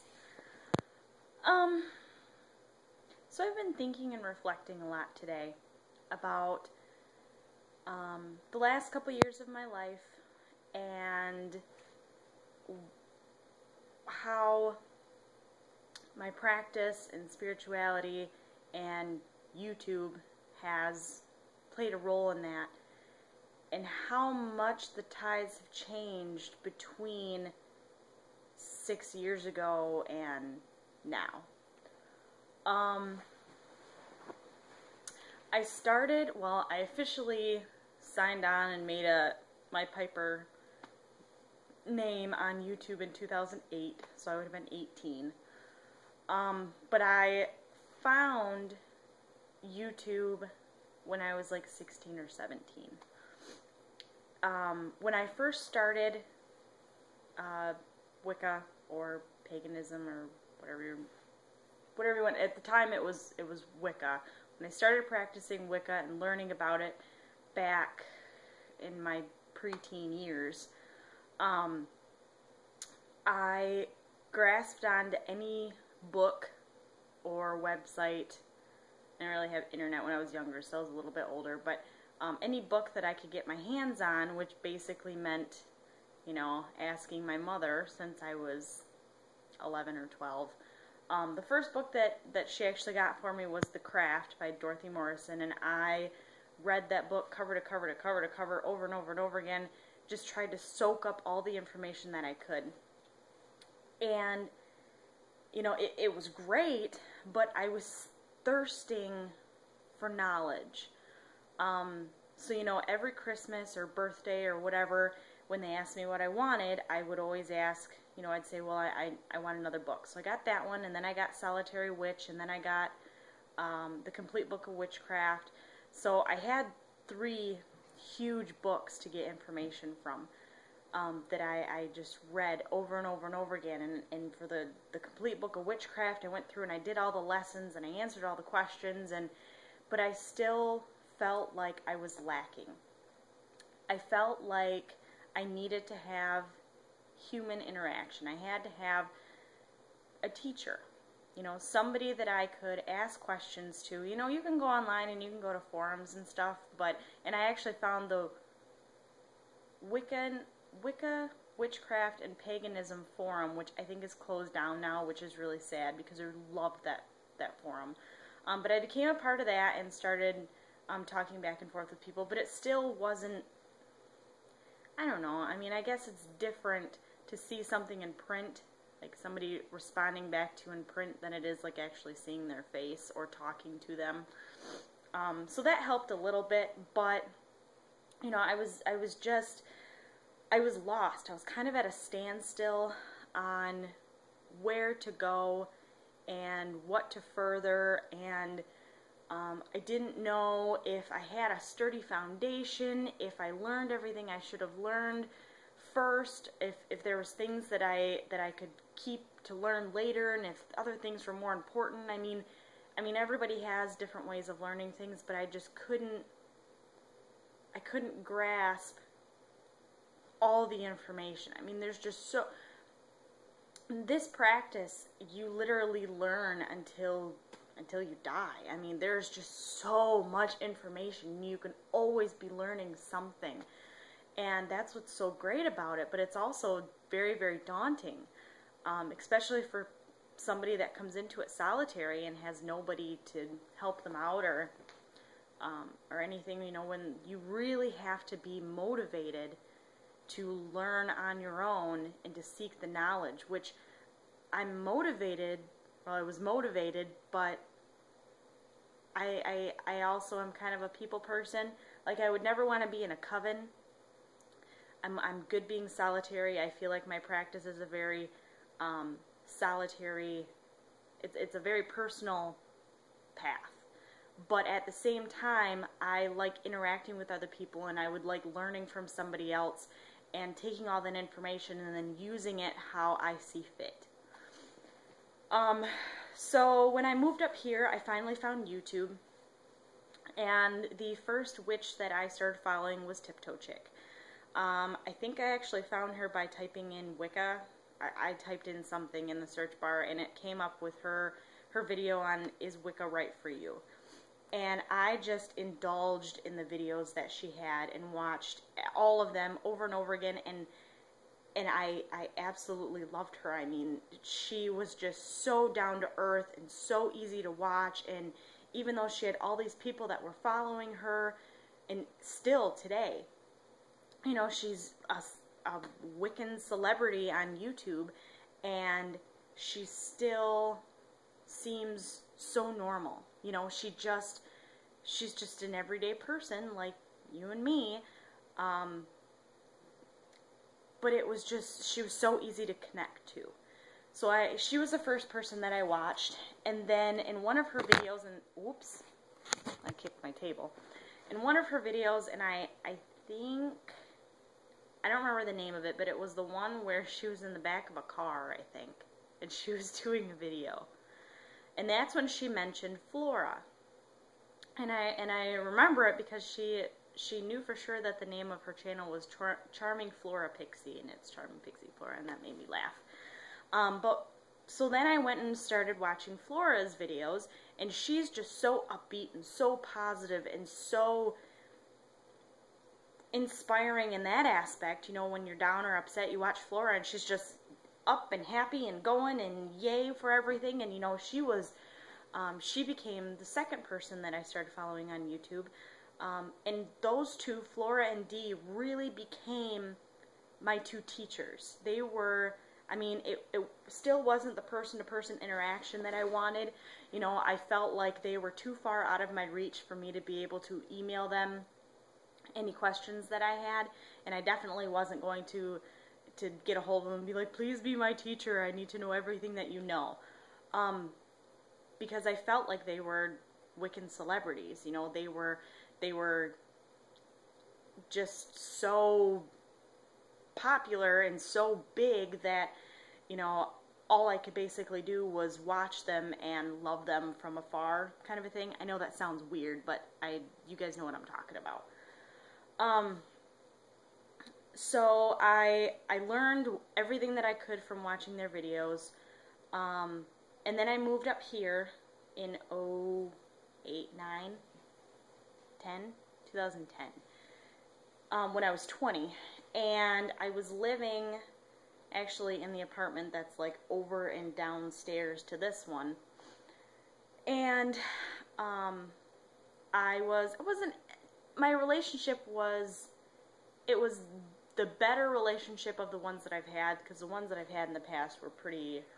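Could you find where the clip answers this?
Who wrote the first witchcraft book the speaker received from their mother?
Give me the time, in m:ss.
1:34.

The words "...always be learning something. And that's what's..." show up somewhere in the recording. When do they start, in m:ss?
3:51.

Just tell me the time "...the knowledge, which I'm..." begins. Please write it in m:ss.
4:12.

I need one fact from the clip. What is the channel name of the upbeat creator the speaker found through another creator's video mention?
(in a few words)
Charming Pixie Flora.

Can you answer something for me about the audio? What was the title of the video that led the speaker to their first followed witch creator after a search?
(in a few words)
Is Wicca Right For You?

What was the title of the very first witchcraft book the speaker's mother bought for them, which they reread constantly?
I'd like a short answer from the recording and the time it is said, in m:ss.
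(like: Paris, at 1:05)
The Craft, at 1:33.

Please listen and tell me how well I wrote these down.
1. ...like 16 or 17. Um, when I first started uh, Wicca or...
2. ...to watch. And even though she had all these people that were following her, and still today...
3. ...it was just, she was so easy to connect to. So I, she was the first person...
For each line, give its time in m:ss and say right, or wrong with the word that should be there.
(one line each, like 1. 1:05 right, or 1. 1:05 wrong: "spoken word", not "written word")
1. 0:51 right
2. 5:17 right
3. 5:41 right.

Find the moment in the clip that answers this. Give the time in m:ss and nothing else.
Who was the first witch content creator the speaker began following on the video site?
4:53.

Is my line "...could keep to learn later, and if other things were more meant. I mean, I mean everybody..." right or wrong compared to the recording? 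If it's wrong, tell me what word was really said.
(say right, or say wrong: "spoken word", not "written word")
wrong: "important", not "meant".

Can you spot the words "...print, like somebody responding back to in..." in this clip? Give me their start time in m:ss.
2:58.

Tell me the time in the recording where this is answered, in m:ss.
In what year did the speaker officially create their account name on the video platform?
0:43.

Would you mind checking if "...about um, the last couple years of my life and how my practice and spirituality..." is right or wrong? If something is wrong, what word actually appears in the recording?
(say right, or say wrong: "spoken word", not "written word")
right.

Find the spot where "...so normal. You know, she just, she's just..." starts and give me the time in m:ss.
5:32.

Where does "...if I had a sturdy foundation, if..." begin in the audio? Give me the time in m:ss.
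3:20.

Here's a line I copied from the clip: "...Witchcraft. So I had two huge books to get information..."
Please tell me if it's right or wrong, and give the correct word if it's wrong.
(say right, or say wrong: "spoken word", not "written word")
wrong: "three", not "two".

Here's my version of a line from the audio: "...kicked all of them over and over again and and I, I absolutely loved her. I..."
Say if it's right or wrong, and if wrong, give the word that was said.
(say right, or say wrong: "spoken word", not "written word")
wrong: "watched", not "kicked".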